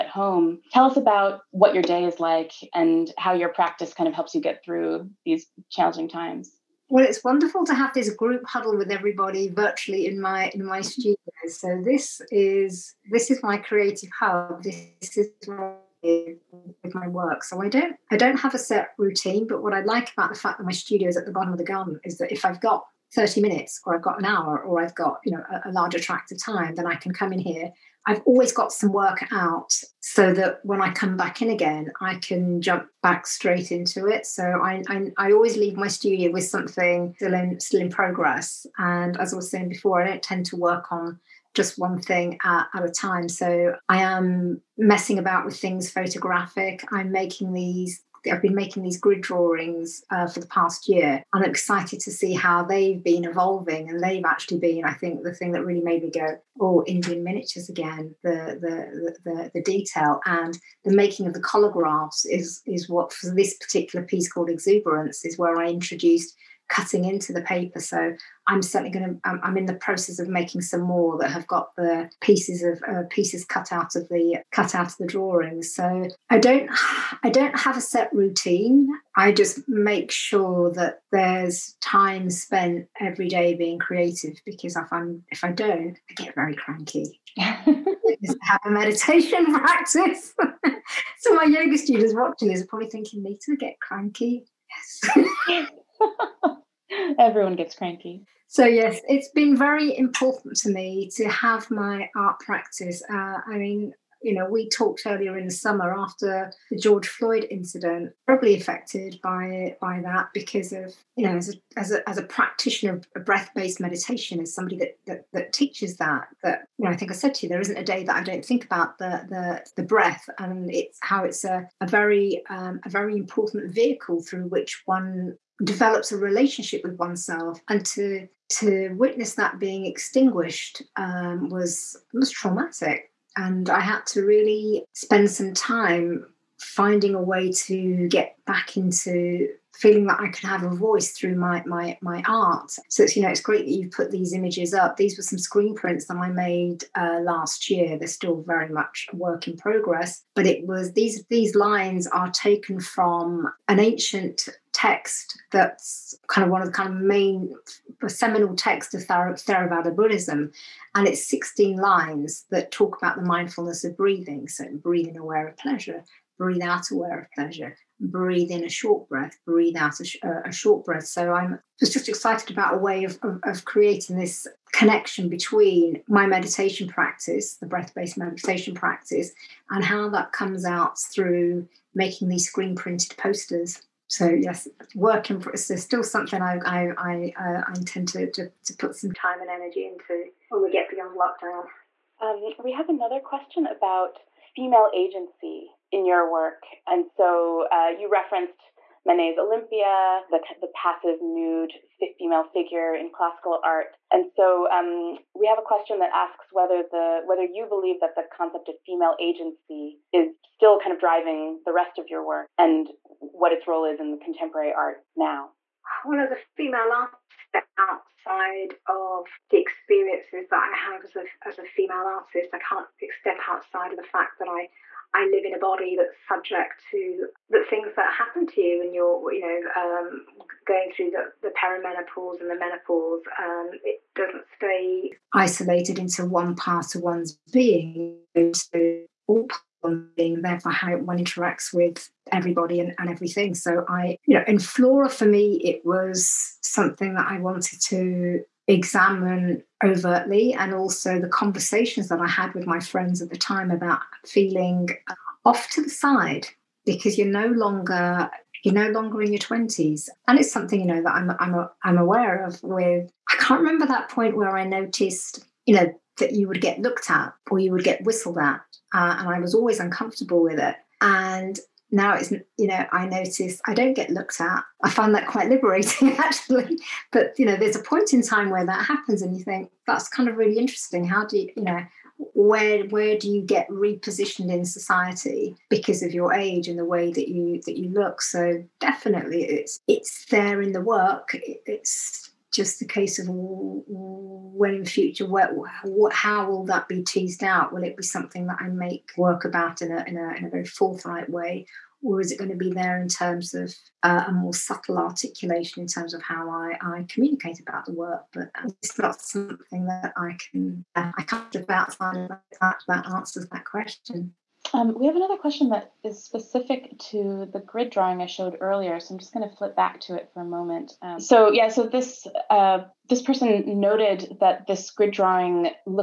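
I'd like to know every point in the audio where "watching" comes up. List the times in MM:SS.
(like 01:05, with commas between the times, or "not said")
01:32.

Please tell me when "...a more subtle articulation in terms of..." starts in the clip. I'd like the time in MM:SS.
05:04.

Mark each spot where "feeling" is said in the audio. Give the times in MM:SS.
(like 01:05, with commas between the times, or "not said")
02:19, 04:14.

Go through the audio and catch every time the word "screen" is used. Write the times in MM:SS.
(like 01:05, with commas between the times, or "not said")
02:25, 03:02.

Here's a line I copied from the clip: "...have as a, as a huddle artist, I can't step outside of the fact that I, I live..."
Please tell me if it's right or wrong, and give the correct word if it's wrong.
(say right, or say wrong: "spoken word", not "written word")
wrong: "female", not "huddle".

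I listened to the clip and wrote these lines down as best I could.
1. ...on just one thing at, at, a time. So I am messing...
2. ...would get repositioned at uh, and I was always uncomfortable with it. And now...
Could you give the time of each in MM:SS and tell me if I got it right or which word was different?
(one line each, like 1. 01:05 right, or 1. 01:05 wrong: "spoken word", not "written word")
1. 00:40 right
2. 04:27 wrong: "whistled", not "repositioned".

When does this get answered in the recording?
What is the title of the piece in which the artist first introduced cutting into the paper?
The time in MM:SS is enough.
01:04.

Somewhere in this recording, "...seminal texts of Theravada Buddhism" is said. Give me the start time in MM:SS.
02:38.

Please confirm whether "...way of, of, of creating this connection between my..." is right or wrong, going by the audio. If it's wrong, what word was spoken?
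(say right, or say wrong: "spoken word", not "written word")
right.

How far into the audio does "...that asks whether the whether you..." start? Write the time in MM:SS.
03:25.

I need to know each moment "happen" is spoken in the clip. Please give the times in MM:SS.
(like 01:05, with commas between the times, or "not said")
03:48, 04:38.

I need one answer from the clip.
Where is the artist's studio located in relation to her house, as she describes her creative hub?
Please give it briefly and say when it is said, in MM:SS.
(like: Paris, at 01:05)
At the bottom of the garden, at 00:21.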